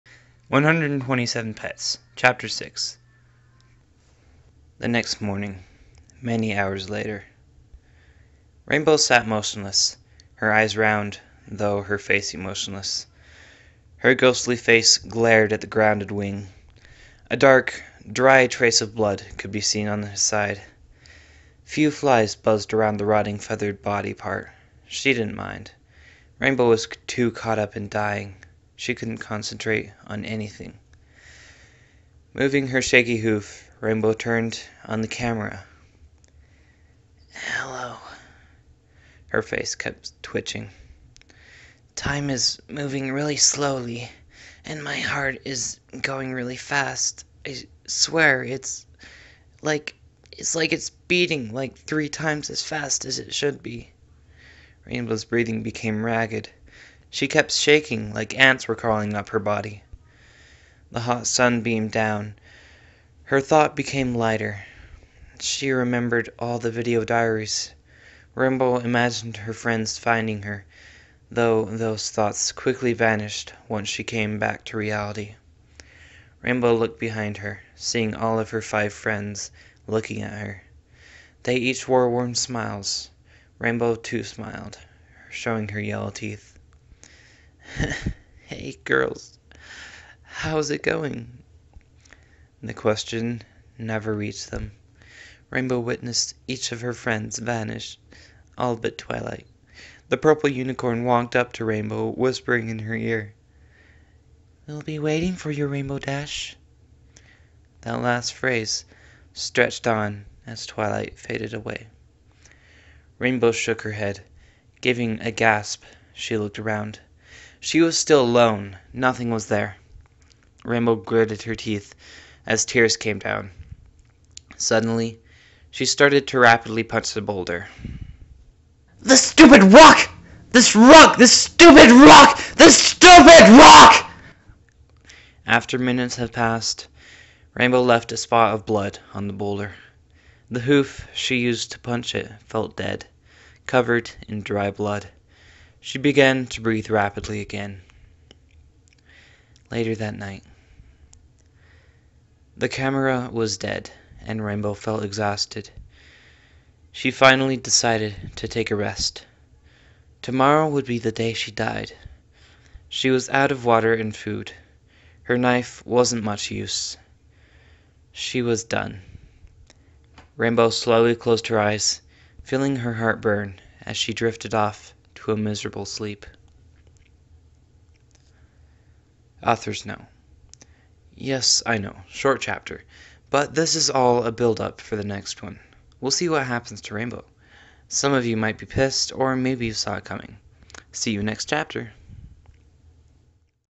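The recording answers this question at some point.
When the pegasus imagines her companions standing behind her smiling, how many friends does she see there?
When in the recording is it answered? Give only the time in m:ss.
1:18.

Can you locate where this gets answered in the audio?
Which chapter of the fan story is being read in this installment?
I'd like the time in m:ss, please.
0:02.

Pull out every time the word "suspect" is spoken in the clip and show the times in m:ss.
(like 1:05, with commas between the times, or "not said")
not said.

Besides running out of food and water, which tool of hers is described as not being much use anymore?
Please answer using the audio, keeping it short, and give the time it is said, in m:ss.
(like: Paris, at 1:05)
Her knife, at 2:45.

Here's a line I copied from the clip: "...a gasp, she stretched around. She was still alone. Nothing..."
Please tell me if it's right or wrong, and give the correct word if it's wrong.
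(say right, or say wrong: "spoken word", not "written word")
wrong: "looked", not "stretched".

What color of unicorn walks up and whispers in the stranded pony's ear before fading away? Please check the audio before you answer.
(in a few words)
Purple.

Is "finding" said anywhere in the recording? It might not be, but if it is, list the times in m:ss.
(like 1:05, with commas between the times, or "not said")
1:09.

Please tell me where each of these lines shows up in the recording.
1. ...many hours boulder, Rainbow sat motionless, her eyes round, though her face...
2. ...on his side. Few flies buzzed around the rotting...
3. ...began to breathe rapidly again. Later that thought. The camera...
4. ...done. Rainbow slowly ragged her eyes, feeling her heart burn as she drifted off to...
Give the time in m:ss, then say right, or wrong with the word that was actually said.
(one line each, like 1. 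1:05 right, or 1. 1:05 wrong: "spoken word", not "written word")
1. 0:06 wrong: "later", not "boulder"
2. 0:19 right
3. 2:25 wrong: "night", not "thought"
4. 2:48 wrong: "closed", not "ragged".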